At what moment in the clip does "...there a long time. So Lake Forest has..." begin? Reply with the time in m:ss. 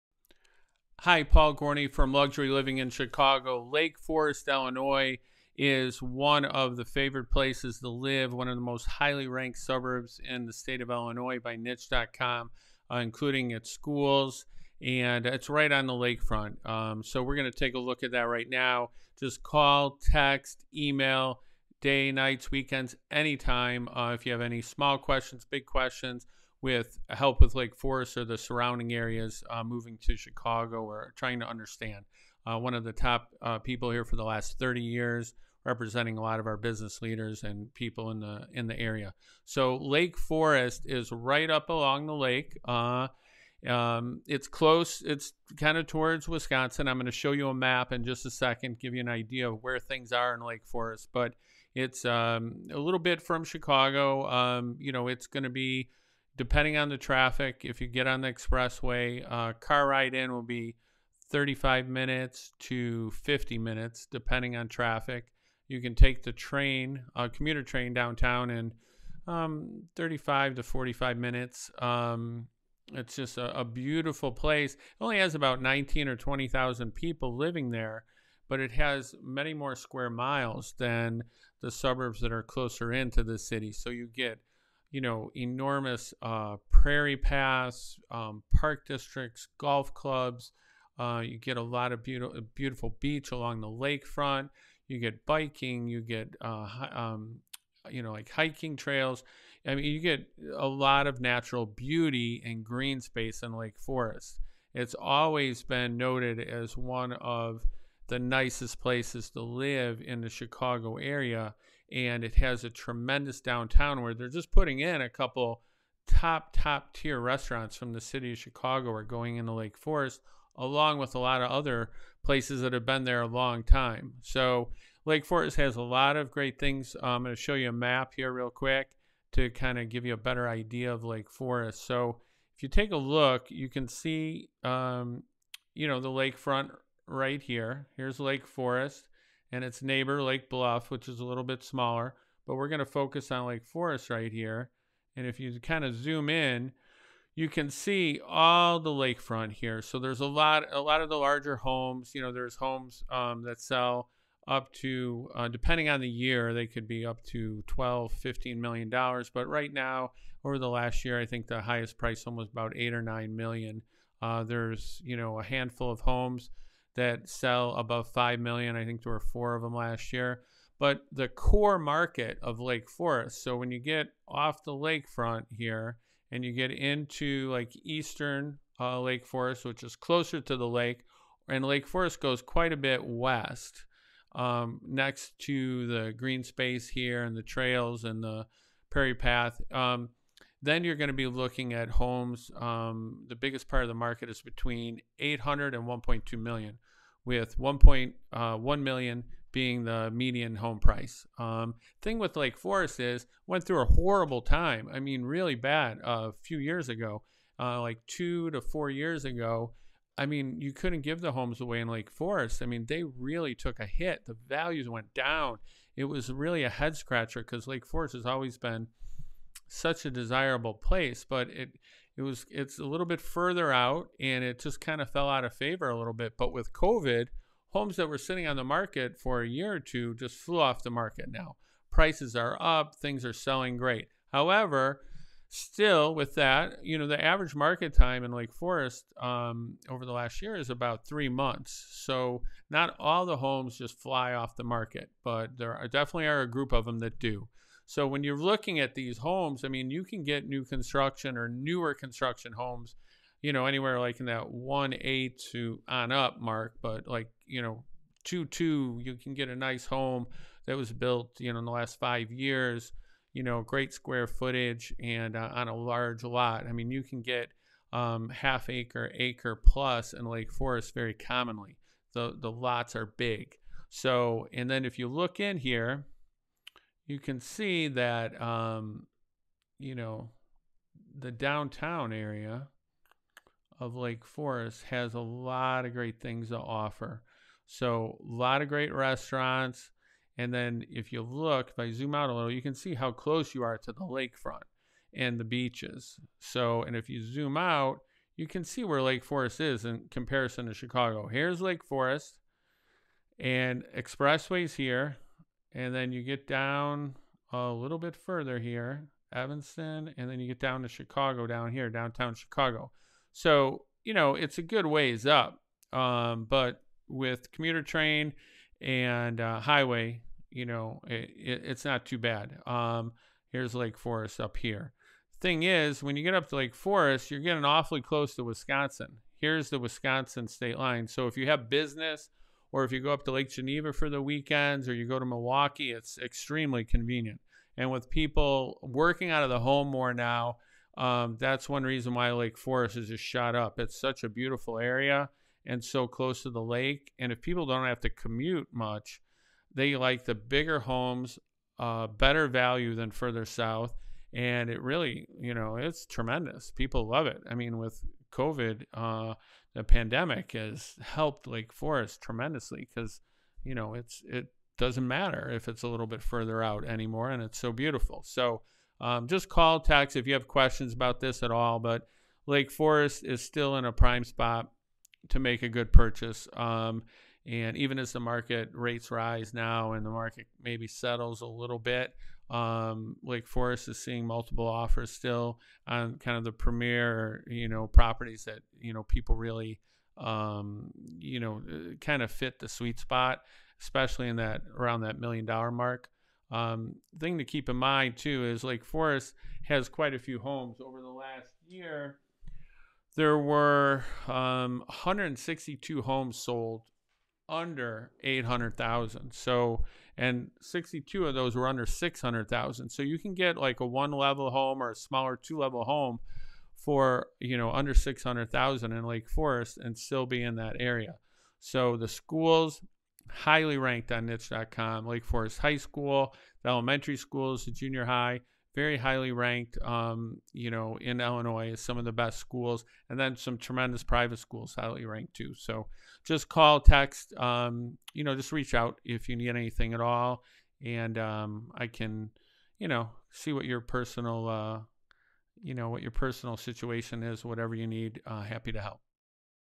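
2:03.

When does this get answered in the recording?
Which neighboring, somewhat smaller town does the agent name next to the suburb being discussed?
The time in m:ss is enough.
2:20.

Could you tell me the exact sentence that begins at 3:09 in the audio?
Um, then you're going to be looking at homes.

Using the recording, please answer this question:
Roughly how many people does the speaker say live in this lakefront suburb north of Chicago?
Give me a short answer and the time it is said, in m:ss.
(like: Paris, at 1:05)
19 or 20,000, at 1:15.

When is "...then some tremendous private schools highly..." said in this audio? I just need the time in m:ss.
7:13.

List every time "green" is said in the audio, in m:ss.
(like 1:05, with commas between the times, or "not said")
1:42, 3:06.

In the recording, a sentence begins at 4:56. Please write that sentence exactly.
So, and if you zoom out, you can see where Lake Forest is in comparison to Chicago.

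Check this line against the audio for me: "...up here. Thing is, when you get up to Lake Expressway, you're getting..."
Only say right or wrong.
wrong.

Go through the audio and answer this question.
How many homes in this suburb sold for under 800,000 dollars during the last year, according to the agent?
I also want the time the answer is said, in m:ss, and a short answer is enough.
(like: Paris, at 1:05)
162, at 6:44.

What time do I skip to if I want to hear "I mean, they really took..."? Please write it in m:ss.
3:32.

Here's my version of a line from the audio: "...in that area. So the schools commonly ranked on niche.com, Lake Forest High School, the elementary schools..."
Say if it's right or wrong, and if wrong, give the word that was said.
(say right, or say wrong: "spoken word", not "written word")
wrong: "highly", not "commonly".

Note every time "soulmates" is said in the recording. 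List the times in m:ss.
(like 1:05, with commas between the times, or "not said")
not said.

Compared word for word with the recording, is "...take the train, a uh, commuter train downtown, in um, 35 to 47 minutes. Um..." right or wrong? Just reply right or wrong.
wrong.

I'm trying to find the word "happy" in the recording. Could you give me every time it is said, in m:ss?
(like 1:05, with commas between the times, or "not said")
7:28.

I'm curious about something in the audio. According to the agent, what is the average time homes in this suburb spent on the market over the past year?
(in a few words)
3 months.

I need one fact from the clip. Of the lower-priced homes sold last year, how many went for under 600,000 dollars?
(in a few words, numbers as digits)
62.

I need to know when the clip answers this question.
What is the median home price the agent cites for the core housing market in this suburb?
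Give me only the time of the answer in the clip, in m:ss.
3:17.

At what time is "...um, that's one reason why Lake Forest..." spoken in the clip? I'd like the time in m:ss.
5:40.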